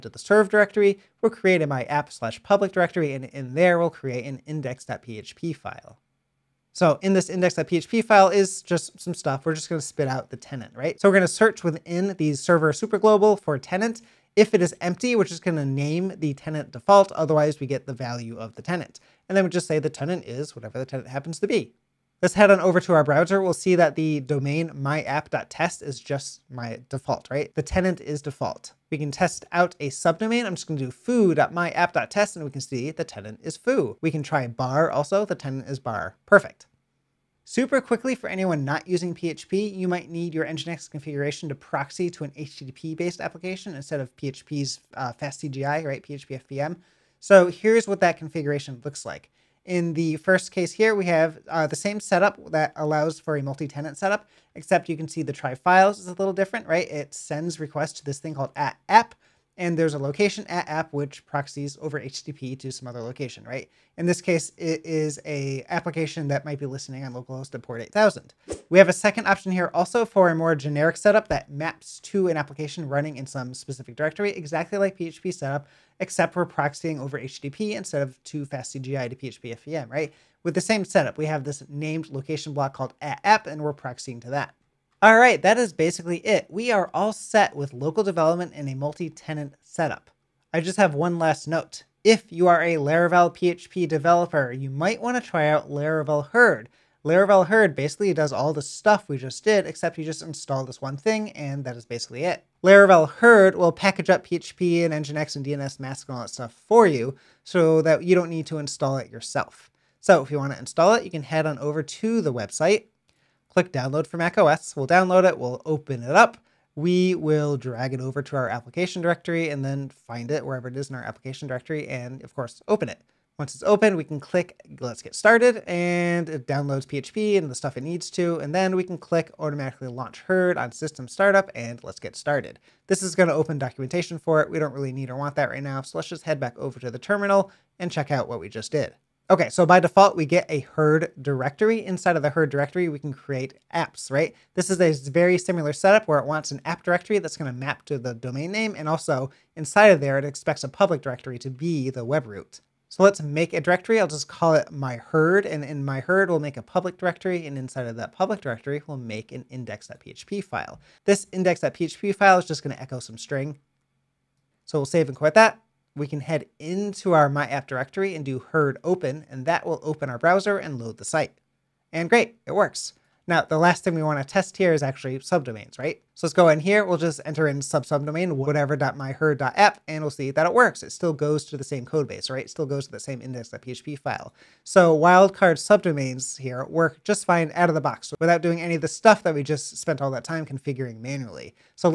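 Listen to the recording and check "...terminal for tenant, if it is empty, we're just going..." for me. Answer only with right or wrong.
wrong.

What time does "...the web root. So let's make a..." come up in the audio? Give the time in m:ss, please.
2:31.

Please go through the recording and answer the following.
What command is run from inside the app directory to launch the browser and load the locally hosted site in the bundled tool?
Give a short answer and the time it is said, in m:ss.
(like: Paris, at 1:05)
herd open, at 2:48.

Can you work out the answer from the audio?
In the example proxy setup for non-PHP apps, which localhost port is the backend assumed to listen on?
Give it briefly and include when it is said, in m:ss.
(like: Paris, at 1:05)
8000, at 1:07.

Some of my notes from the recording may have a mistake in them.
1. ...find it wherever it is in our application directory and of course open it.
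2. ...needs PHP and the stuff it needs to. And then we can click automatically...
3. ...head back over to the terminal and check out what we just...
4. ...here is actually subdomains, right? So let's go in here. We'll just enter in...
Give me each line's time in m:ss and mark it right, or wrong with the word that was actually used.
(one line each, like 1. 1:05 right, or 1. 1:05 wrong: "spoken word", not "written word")
1. 1:59 right
2. 2:06 wrong: "downloads", not "needs"
3. 2:16 right
4. 2:54 right.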